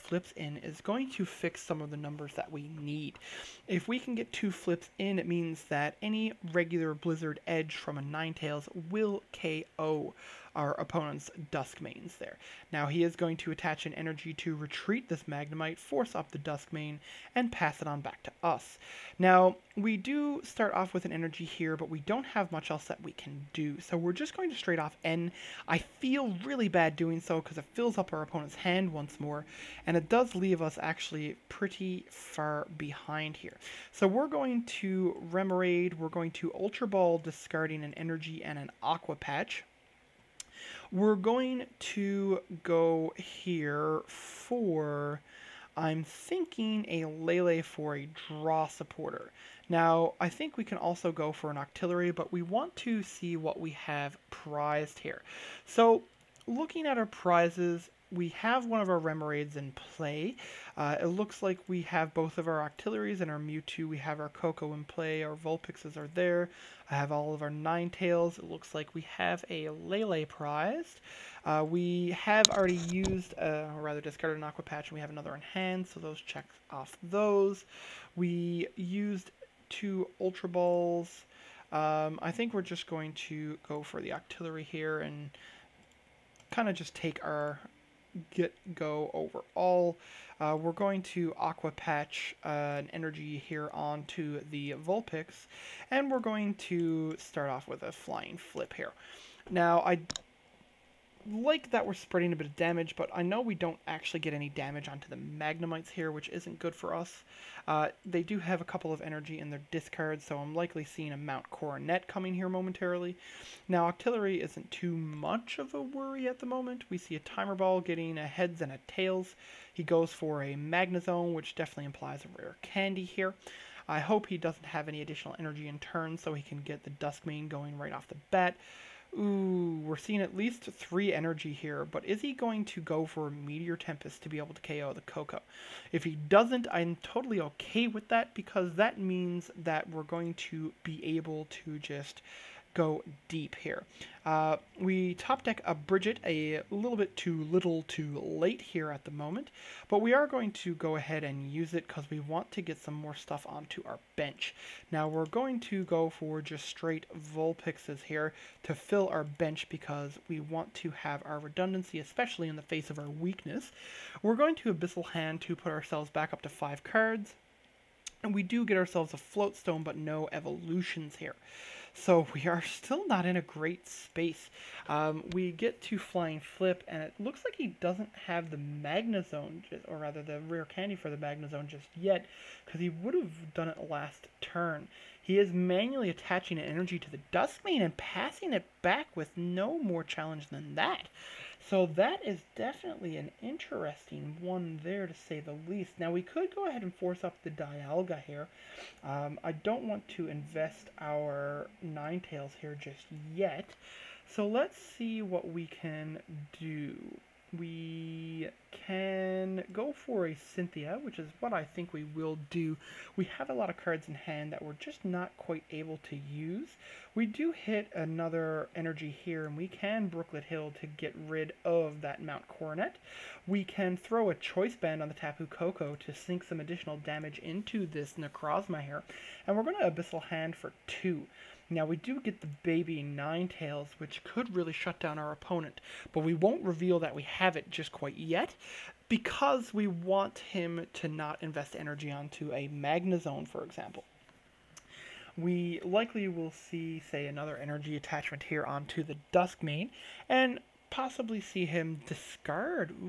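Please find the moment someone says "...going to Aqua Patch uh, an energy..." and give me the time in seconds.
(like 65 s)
90 s.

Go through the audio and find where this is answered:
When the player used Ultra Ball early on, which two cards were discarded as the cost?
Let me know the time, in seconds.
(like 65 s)
37 s.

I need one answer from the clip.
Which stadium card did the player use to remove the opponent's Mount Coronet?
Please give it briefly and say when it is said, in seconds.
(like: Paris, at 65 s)
Brooklet Hill, at 220 s.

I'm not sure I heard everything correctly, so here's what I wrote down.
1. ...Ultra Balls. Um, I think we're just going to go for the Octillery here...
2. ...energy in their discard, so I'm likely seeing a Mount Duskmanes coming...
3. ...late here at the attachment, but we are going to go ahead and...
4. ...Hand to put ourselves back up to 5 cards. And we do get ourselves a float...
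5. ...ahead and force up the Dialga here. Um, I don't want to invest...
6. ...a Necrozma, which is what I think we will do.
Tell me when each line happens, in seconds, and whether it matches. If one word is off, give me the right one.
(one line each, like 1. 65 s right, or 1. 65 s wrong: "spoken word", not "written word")
1. 80 s right
2. 109 s wrong: "Coronet", not "Duskmanes"
3. 148 s wrong: "moment", not "attachment"
4. 165 s right
5. 196 s right
6. 210 s wrong: "Cynthia", not "Necrozma".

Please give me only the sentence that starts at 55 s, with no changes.
So, looking at our prizes, we have one of our Remoraid's in play.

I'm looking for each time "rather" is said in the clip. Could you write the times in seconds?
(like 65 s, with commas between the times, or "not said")
73 s, 179 s.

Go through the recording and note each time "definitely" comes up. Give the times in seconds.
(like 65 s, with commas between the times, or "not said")
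121 s, 192 s.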